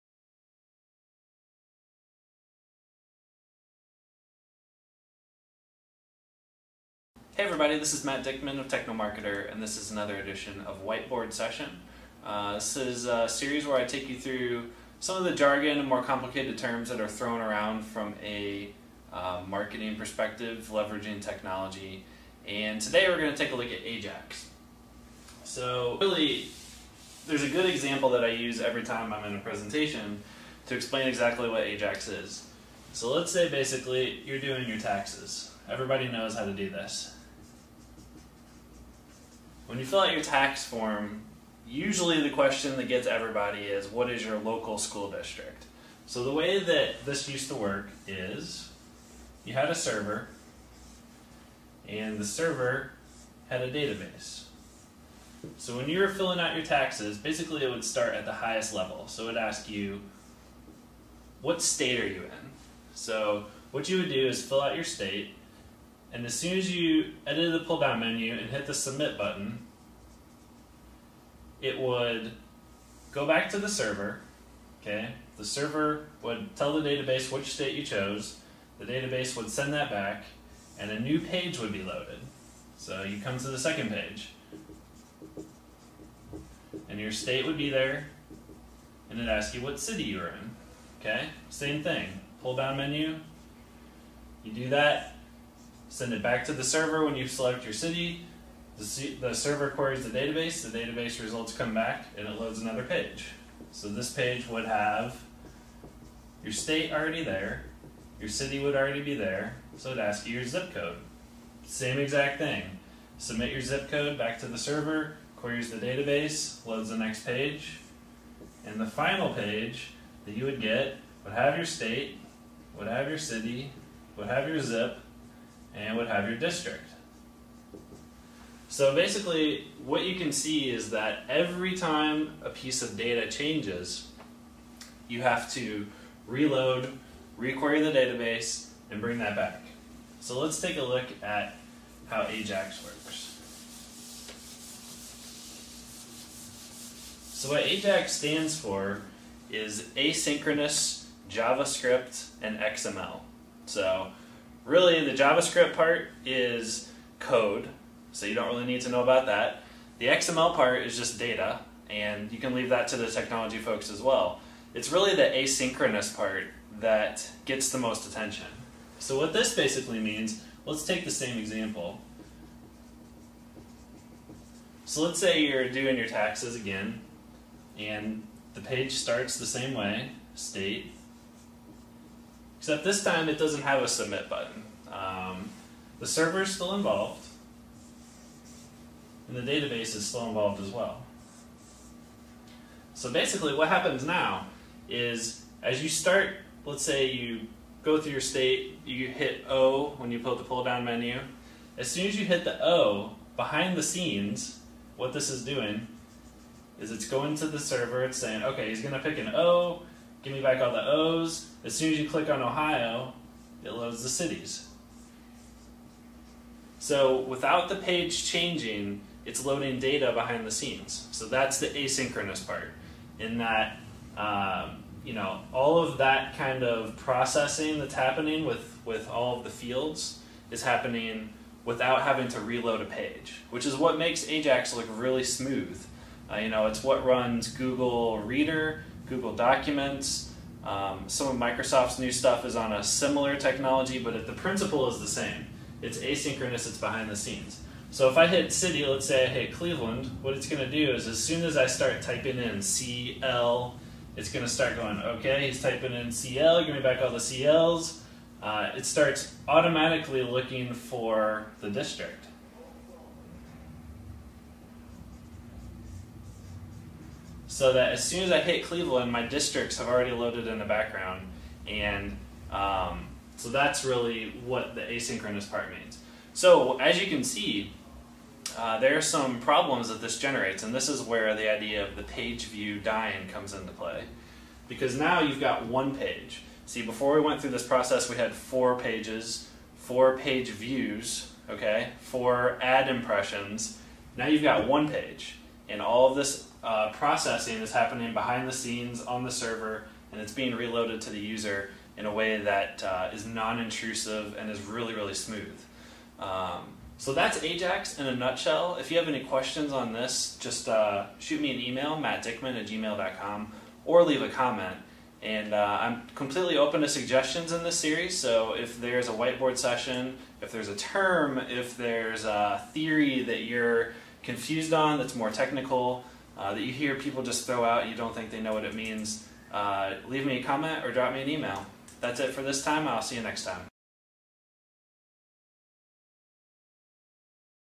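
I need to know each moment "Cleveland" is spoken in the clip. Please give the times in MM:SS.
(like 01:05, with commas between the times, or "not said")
04:09, 04:28.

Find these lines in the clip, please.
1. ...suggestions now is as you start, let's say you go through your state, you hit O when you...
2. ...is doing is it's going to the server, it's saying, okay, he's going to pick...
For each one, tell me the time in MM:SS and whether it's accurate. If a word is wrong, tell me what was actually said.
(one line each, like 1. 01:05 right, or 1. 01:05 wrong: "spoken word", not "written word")
1. 03:13 wrong: "happens", not "suggestions"
2. 03:25 right.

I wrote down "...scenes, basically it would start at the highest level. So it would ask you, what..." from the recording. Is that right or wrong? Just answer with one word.
wrong.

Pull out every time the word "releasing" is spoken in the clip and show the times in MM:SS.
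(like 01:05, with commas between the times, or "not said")
not said.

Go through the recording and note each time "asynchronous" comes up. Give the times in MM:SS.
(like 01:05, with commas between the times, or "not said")
02:29, 02:45, 03:41, 04:05, 04:34.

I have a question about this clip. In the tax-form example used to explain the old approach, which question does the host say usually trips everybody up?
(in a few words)
local school district.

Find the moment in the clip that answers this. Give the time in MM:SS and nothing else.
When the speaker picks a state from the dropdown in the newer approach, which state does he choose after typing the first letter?
03:32.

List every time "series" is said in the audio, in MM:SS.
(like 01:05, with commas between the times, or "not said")
00:13, 05:17.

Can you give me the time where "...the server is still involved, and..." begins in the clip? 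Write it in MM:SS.
03:05.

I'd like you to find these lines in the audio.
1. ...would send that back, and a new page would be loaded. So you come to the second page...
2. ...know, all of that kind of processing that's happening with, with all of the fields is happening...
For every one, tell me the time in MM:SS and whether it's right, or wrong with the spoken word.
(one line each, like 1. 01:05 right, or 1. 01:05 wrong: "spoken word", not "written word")
1. 01:19 right
2. 03:45 right.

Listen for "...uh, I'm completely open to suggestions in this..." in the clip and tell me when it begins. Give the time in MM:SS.
05:15.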